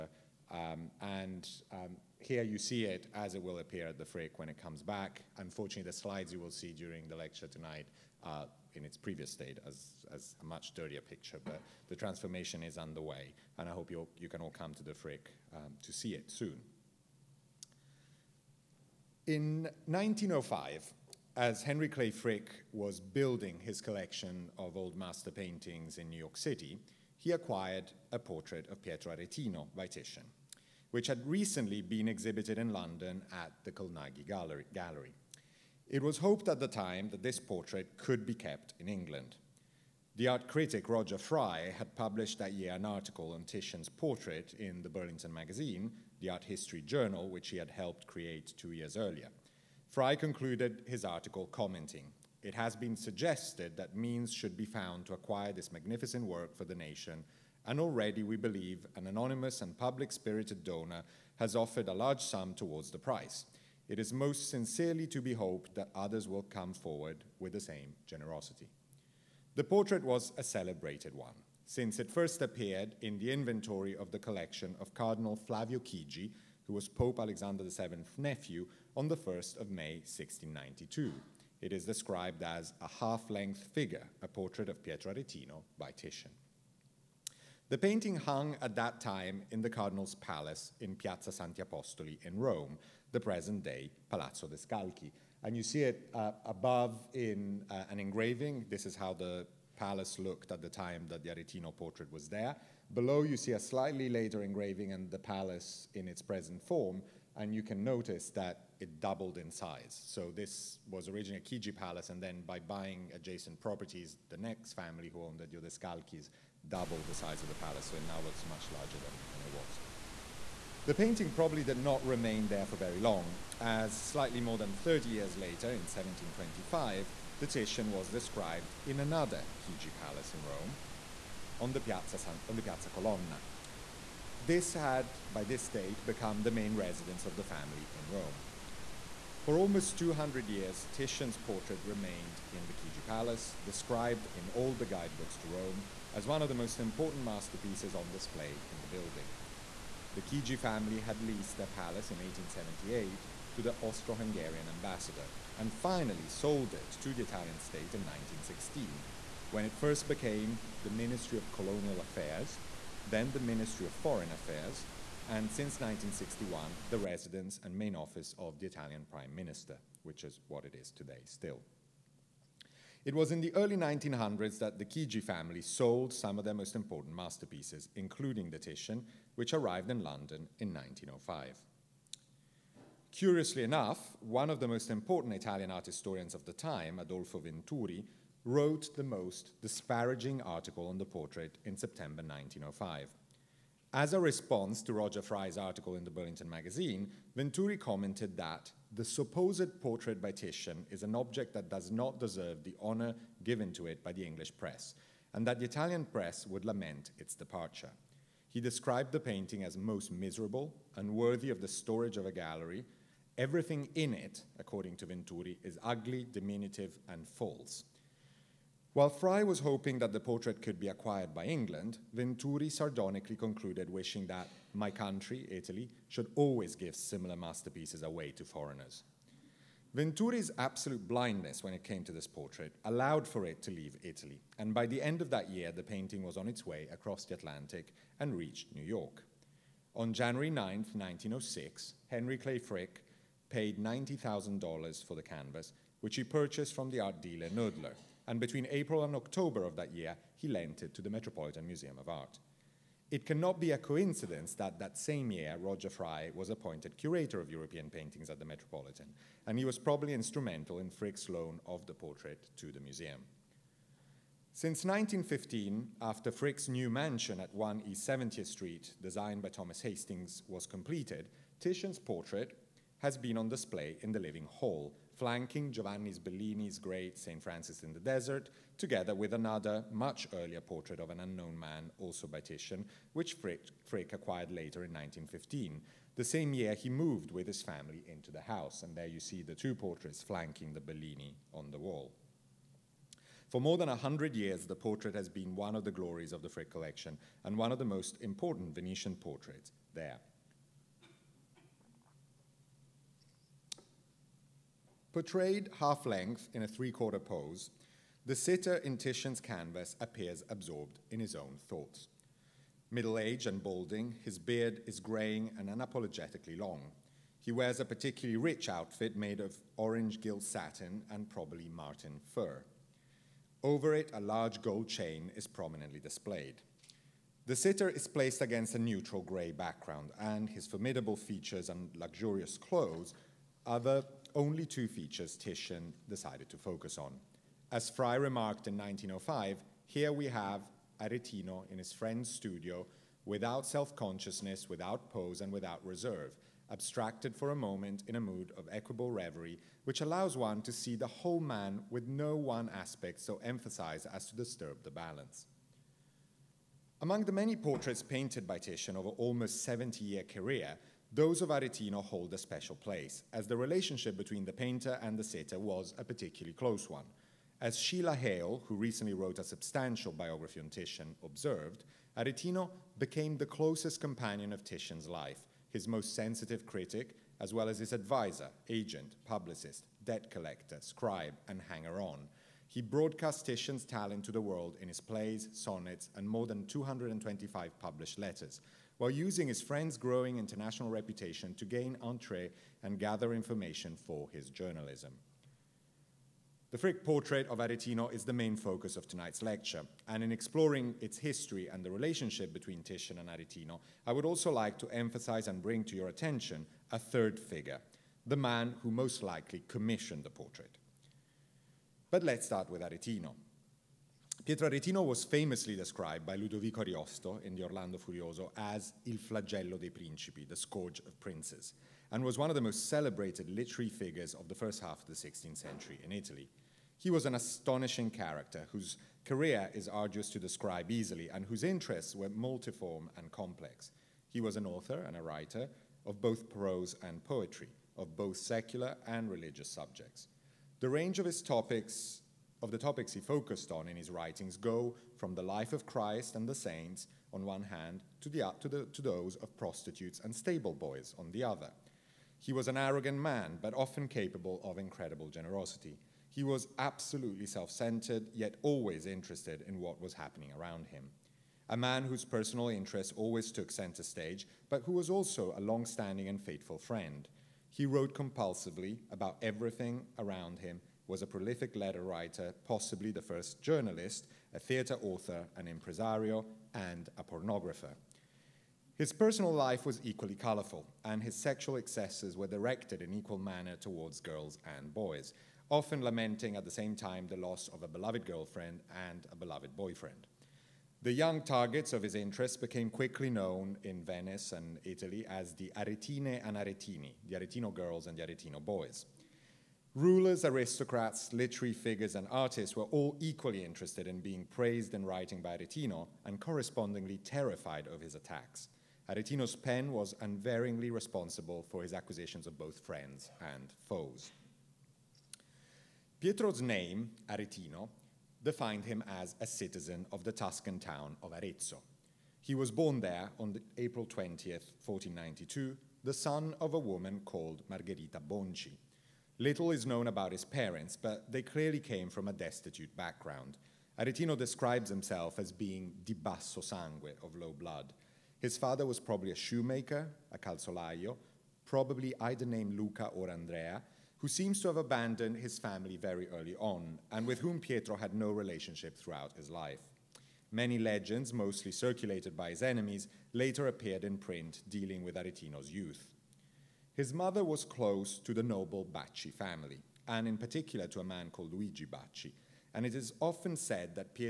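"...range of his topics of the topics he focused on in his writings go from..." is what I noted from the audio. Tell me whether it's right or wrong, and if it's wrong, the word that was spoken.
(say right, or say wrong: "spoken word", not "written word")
right.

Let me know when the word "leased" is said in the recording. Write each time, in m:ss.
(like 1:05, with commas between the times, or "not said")
2:31.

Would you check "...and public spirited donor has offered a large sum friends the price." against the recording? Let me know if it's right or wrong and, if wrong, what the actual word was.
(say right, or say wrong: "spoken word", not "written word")
wrong: "towards", not "friends".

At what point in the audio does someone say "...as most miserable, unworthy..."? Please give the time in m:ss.
3:29.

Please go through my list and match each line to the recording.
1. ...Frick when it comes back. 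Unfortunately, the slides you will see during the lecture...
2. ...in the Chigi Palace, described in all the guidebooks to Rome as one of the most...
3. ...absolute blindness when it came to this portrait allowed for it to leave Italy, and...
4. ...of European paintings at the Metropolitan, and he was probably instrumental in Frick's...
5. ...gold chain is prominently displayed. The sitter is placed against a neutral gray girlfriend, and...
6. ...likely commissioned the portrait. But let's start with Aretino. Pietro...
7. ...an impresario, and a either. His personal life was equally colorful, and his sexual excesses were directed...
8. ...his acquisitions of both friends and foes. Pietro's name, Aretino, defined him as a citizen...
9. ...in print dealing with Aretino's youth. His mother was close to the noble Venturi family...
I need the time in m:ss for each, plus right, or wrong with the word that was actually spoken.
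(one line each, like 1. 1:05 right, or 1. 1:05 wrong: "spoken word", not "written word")
1. 0:04 right
2. 2:22 right
3. 3:50 right
4. 4:17 right
5. 5:24 wrong: "background", not "girlfriend"
6. 6:49 right
7. 7:55 wrong: "pornographer", not "either"
8. 8:31 right
9. 9:14 wrong: "Bacci", not "Venturi".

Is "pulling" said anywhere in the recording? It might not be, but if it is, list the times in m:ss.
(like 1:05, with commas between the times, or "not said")
not said.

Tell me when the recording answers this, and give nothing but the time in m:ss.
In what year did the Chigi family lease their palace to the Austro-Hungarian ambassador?
2:32.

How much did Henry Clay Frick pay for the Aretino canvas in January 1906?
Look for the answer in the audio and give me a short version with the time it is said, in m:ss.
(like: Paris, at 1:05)
$90,000, at 4:03.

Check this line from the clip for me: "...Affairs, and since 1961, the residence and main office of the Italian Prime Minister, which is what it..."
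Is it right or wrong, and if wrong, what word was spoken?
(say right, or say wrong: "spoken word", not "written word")
right.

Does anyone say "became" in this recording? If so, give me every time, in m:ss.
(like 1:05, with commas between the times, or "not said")
2:40, 6:12, 8:12.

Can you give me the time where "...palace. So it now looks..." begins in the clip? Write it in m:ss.
1:57.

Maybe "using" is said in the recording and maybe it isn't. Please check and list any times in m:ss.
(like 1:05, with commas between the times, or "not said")
6:29.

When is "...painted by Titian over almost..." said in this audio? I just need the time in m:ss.
5:58.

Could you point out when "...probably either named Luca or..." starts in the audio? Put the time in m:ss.
9:01.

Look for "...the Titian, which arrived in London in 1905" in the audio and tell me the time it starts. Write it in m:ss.
2:58.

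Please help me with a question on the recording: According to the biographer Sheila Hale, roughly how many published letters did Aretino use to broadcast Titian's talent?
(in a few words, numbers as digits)
225.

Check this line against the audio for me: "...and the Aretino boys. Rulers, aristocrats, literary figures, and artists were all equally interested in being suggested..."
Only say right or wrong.
wrong.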